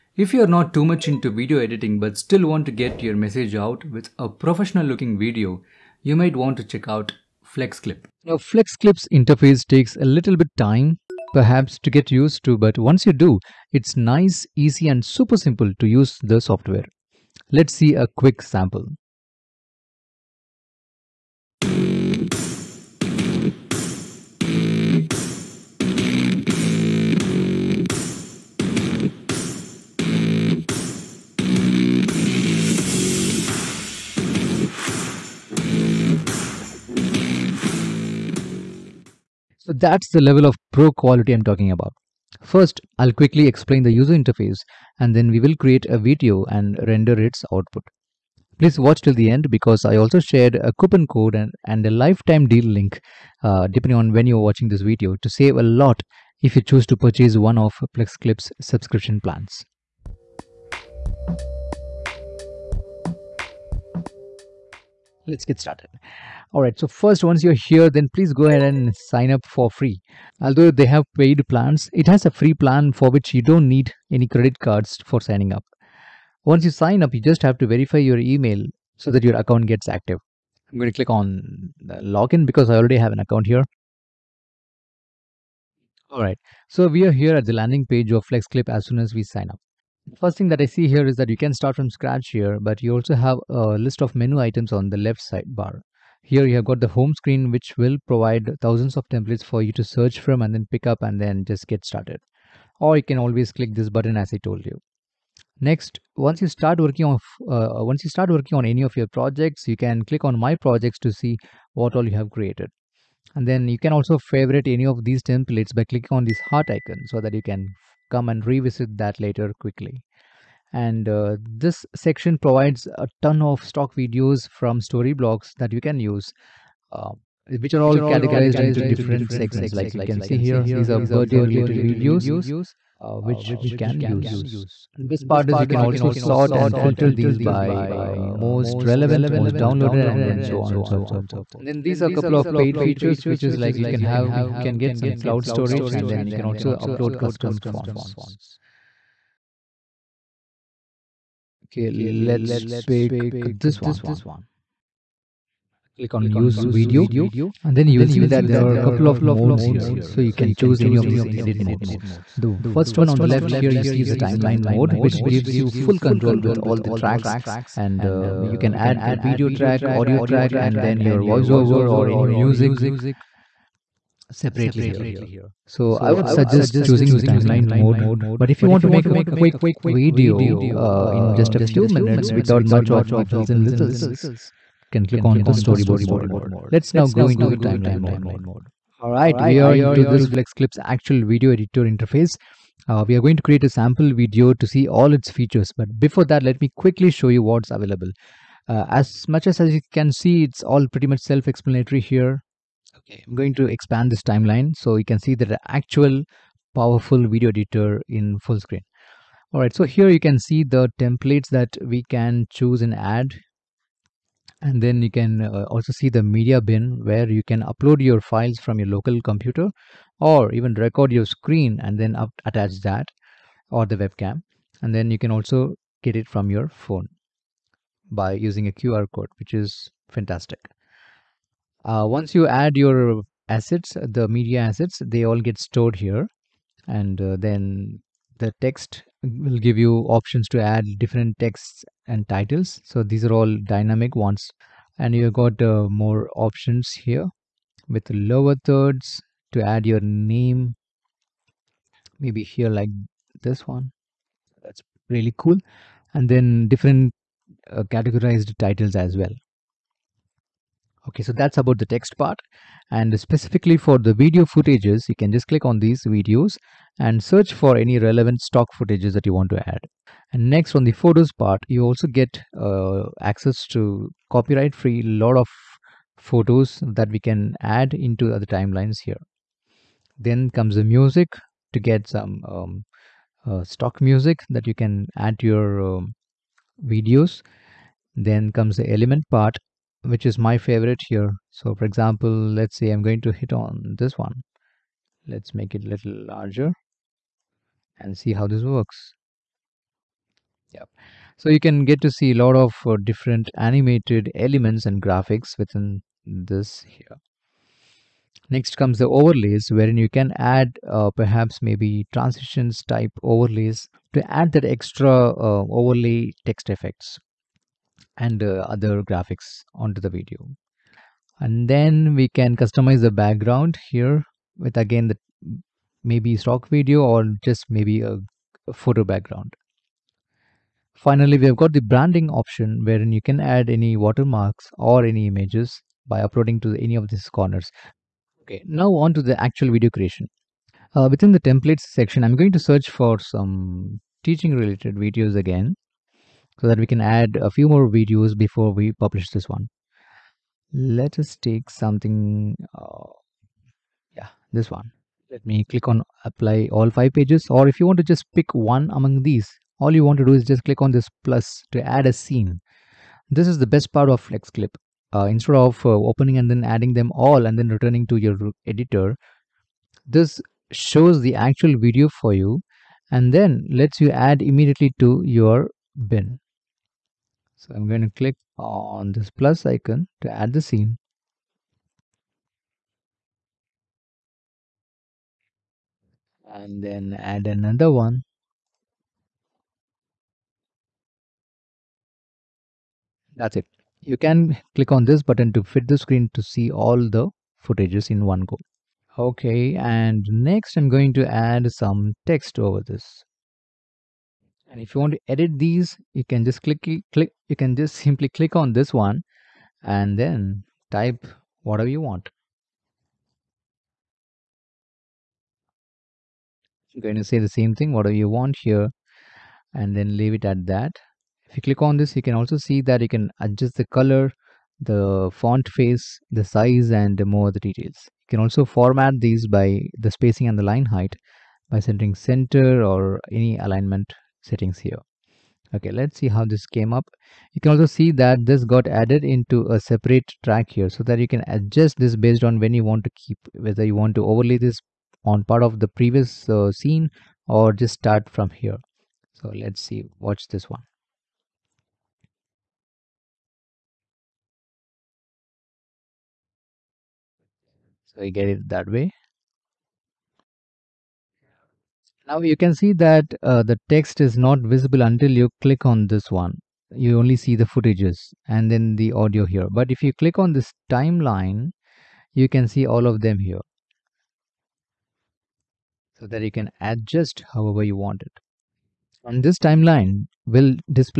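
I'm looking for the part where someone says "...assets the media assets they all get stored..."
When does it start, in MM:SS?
03:53.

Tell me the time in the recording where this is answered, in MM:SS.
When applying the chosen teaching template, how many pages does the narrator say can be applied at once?
05:56.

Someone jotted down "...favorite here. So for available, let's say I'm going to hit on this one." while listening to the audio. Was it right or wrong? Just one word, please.
wrong.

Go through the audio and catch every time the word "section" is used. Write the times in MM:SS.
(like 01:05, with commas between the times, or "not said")
02:01, 05:41.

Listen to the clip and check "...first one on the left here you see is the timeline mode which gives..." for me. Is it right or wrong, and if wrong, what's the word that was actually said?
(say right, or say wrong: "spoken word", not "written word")
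right.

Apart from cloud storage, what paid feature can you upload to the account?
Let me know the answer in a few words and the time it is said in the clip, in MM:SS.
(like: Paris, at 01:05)
Custom fonts, at 02:27.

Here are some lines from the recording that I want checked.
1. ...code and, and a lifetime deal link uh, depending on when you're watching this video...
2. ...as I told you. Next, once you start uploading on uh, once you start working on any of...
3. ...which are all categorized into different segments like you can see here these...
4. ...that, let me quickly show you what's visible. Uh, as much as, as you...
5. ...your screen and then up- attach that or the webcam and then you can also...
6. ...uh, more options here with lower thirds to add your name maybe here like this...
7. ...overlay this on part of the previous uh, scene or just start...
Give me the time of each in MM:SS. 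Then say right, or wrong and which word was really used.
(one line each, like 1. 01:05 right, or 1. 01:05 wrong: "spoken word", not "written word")
1. 00:51 right
2. 01:44 wrong: "working", not "uploading"
3. 02:07 right
4. 03:16 wrong: "available", not "visible"
5. 03:41 right
6. 04:05 right
7. 07:24 right.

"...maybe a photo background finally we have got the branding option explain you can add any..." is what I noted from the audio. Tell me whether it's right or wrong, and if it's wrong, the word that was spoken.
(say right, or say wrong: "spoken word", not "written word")
wrong: "wherein", not "explain".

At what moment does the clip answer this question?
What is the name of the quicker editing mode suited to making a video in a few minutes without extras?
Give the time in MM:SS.
03:05.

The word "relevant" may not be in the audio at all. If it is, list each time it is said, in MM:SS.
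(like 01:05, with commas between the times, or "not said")
02:18, 04:27.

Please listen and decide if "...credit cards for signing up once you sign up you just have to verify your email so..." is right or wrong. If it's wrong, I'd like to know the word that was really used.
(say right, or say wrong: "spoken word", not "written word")
right.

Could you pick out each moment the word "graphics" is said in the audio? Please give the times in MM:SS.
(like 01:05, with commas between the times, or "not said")
05:05, 05:19.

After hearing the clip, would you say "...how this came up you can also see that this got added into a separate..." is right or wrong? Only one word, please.
right.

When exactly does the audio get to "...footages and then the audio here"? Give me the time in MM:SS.
07:47.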